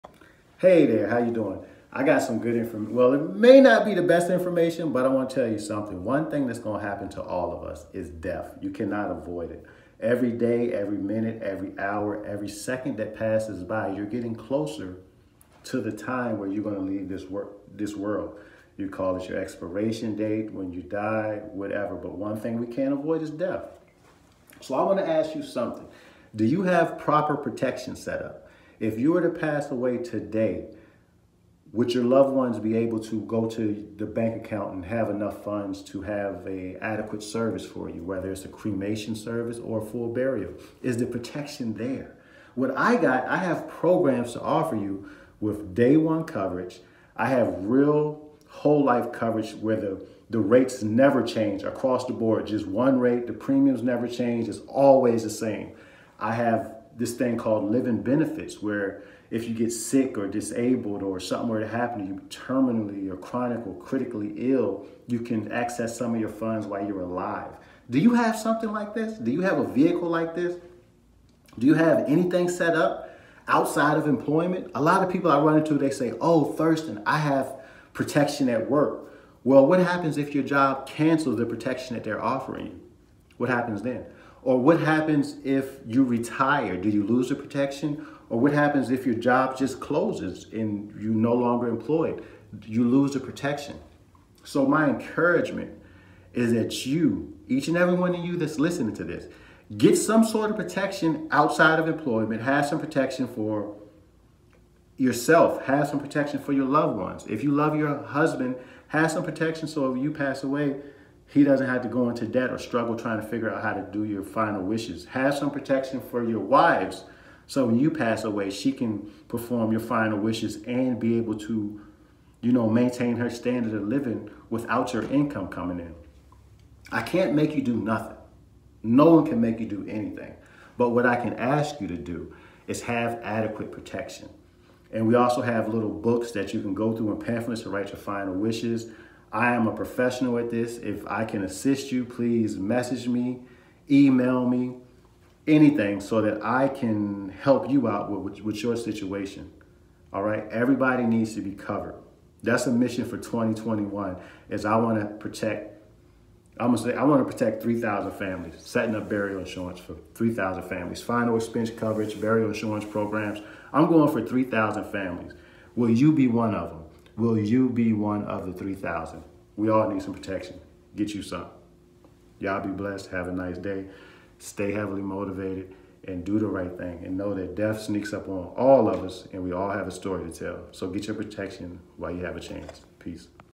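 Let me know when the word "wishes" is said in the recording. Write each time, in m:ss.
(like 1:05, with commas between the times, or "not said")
1:54, 2:00, 2:18.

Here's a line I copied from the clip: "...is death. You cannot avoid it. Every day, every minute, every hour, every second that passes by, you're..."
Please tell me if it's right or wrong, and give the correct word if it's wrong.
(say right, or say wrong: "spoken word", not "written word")
right.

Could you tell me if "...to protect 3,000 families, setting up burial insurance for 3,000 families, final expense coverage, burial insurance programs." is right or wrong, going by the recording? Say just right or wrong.
right.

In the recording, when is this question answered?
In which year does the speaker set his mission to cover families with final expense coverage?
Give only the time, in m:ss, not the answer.
2:33.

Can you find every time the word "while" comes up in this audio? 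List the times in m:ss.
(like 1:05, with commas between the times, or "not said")
1:06, 3:01.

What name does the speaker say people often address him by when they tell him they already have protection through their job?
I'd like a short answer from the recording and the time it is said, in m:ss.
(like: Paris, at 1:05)
Thurston, at 1:16.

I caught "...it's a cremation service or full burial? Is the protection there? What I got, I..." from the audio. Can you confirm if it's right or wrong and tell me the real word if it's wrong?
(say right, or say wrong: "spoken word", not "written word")
right.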